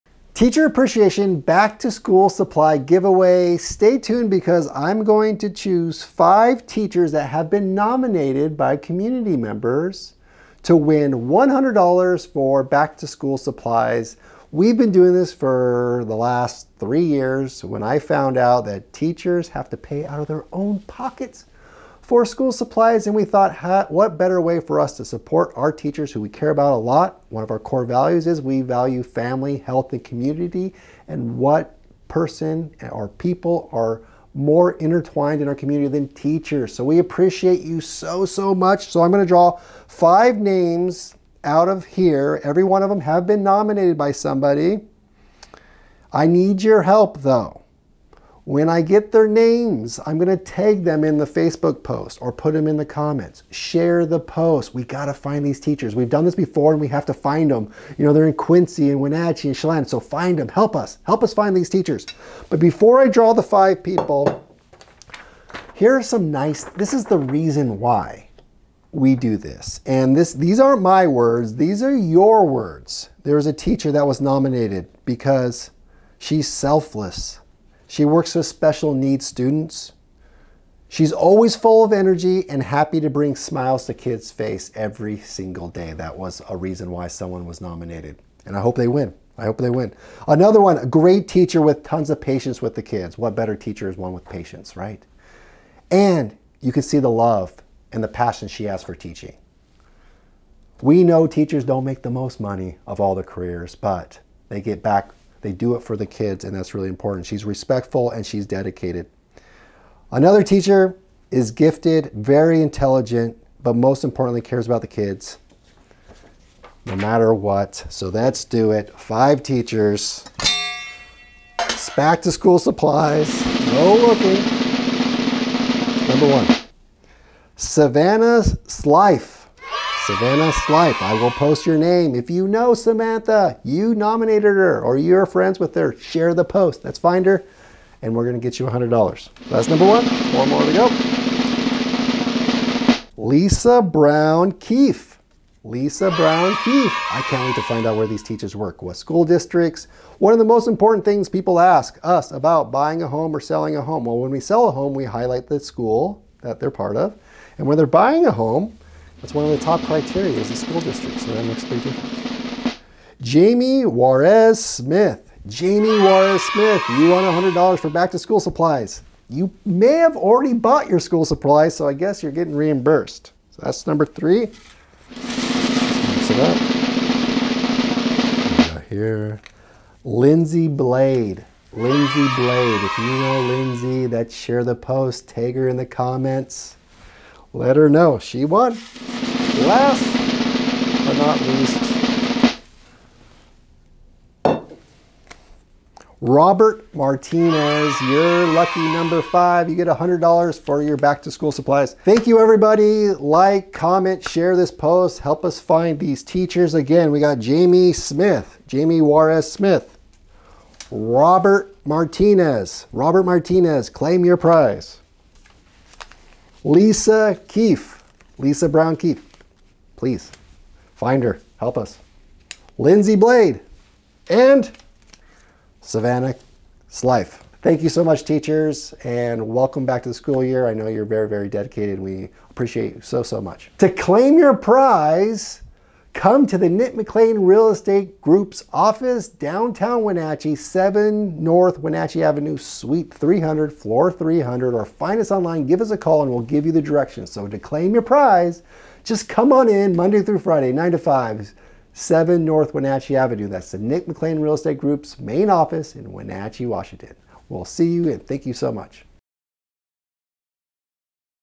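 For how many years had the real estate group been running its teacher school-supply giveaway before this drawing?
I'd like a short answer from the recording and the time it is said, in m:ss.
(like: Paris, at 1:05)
3 years, at 0:16.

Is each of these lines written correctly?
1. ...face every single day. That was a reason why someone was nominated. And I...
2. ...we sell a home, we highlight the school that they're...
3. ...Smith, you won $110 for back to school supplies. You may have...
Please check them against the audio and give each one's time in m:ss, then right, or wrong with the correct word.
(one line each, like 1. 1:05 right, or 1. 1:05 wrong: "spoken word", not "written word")
1. 1:24 right
2. 2:34 right
3. 2:46 wrong: "100", not "110".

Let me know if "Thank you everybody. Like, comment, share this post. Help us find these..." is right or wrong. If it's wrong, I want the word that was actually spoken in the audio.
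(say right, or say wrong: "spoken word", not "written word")
right.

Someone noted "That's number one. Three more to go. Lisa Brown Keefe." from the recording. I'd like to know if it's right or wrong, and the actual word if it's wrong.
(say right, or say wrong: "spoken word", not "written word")
wrong: "Four", not "Three".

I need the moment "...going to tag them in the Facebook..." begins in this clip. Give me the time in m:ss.
0:50.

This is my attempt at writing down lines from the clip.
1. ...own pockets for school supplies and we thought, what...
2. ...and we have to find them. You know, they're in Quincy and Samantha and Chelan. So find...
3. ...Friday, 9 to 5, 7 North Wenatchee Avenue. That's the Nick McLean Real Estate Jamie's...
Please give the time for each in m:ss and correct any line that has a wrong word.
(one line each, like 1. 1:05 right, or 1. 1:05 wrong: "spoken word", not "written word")
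1. 0:20 right
2. 0:56 wrong: "Wenatchee", not "Samantha"
3. 4:10 wrong: "Group", not "Jamie".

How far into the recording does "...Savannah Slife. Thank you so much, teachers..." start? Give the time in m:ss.
3:45.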